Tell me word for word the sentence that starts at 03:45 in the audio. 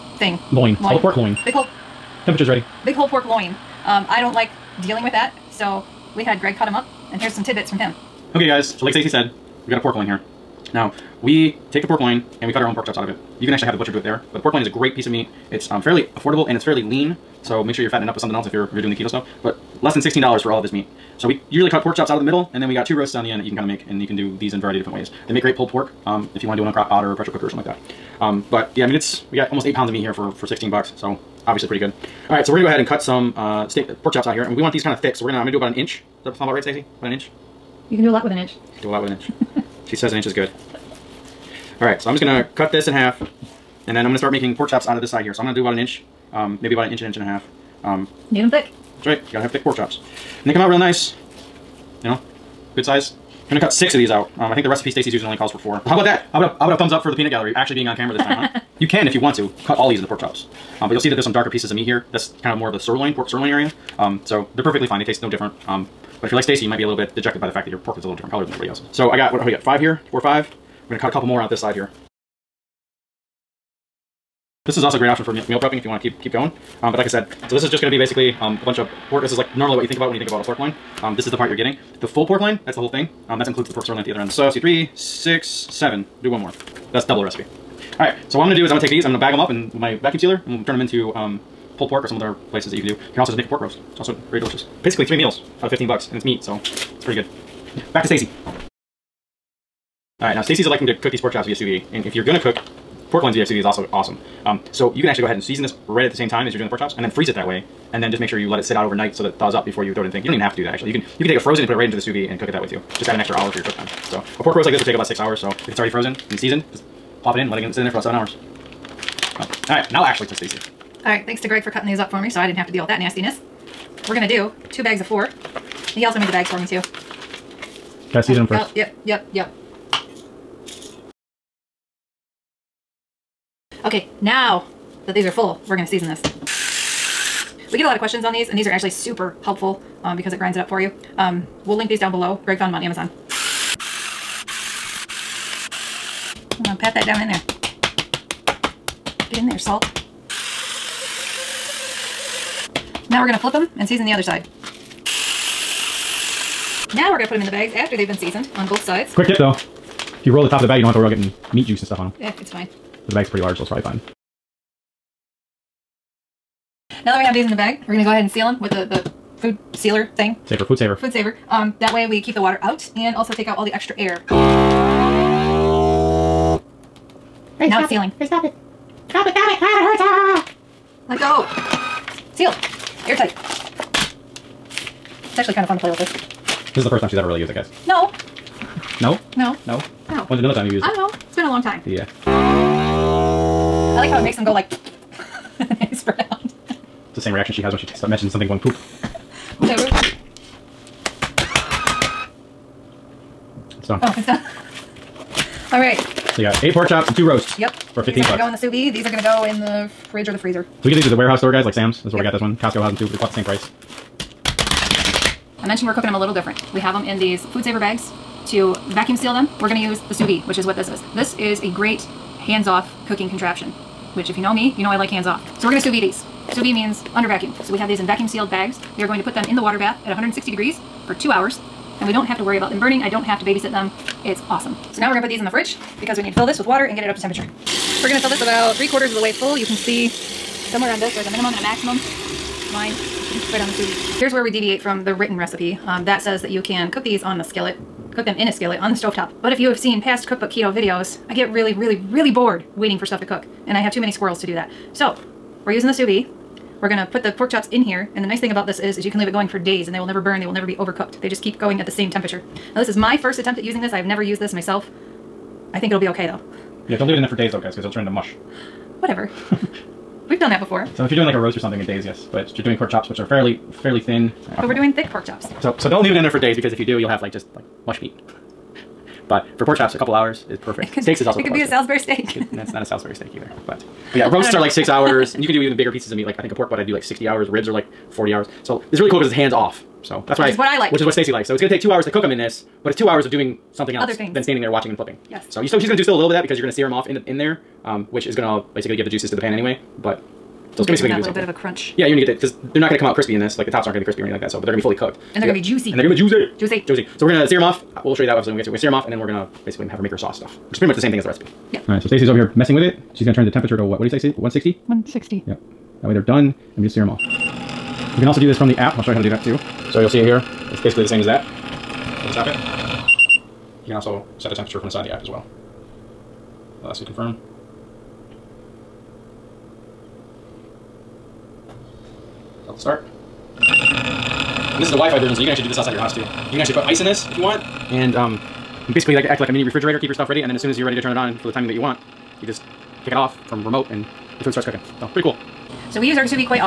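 So we're going to sous vide these.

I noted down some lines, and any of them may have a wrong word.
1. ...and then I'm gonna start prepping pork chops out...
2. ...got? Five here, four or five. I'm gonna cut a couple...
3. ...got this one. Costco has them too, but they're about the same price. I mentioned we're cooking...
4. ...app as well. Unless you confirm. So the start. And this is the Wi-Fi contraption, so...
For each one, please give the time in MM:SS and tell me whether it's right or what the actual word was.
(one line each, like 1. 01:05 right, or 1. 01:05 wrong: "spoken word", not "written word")
1. 00:43 wrong: "making", not "prepping"
2. 01:09 right
3. 03:32 right
4. 05:25 wrong: "version", not "contraption".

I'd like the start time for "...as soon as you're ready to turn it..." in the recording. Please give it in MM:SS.
05:40.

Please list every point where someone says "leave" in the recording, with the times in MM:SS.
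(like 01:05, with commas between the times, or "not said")
04:19, 04:27, 04:36.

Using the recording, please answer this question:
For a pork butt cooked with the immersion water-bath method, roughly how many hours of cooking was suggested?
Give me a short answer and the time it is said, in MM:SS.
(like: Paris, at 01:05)
60 hours, at 04:47.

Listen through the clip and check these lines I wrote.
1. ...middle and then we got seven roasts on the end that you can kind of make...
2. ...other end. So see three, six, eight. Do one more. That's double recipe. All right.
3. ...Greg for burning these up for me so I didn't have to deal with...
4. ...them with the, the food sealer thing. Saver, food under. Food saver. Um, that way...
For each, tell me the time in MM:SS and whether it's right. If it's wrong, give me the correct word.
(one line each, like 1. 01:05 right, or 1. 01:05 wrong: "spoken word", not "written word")
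1. 00:22 wrong: "two", not "seven"
2. 01:24 wrong: "seven", not "eight"
3. 02:01 wrong: "cutting", not "burning"
4. 02:48 wrong: "saver", not "under".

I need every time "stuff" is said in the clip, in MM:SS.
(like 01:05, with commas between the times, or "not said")
00:19, 02:41, 04:13, 05:10, 05:40.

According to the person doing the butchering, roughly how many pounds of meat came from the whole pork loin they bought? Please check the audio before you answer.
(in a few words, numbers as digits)
8 pounds.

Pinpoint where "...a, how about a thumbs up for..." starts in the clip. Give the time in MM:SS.
00:56.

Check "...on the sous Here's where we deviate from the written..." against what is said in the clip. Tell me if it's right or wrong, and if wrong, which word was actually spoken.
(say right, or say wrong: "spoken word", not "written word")
right.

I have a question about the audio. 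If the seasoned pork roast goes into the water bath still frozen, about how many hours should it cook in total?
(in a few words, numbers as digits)
7 hours.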